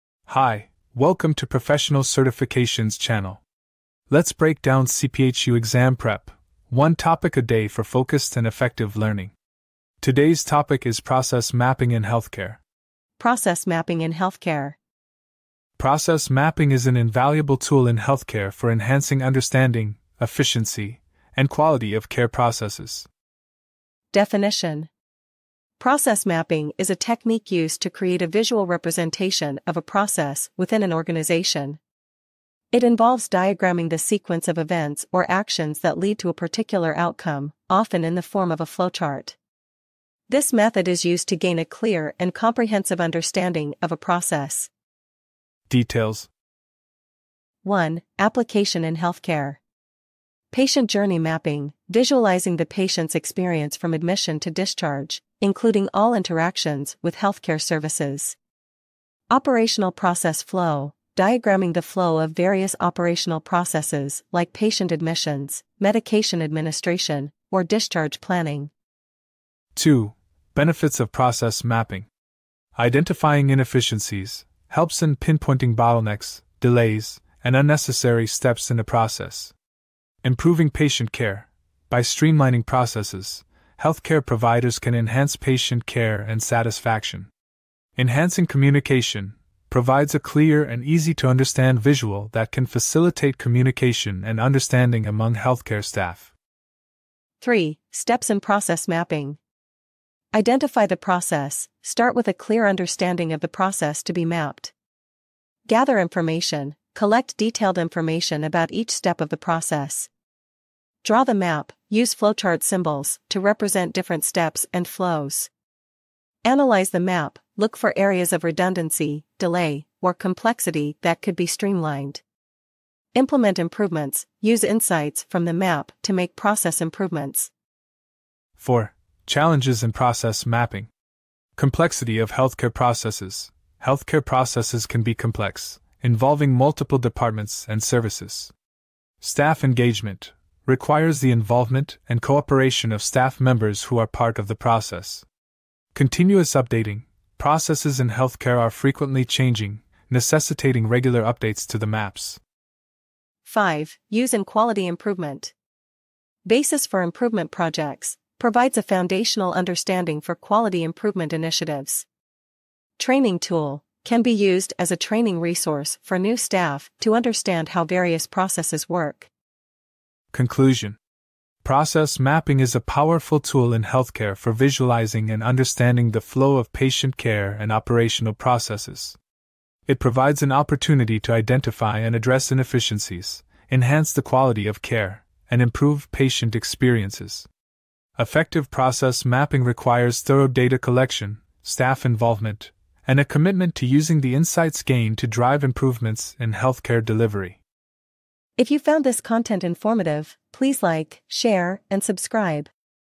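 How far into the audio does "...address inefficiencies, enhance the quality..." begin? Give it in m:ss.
3:02.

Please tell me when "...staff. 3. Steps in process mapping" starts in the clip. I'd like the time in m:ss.
1:35.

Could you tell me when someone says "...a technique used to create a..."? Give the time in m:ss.
0:26.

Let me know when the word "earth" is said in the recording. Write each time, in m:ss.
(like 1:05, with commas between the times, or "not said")
not said.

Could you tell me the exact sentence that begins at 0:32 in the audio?
It involves diagramming the sequence of events or actions that lead to a particular outcome, often in the form of a flowchart.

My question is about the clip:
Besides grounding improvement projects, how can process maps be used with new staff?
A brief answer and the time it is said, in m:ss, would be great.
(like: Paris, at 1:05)
Training tool, at 2:42.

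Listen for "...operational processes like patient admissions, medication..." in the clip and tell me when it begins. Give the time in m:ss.
1:02.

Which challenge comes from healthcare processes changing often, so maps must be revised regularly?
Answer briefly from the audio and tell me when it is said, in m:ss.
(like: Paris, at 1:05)
Continuous updating, at 2:25.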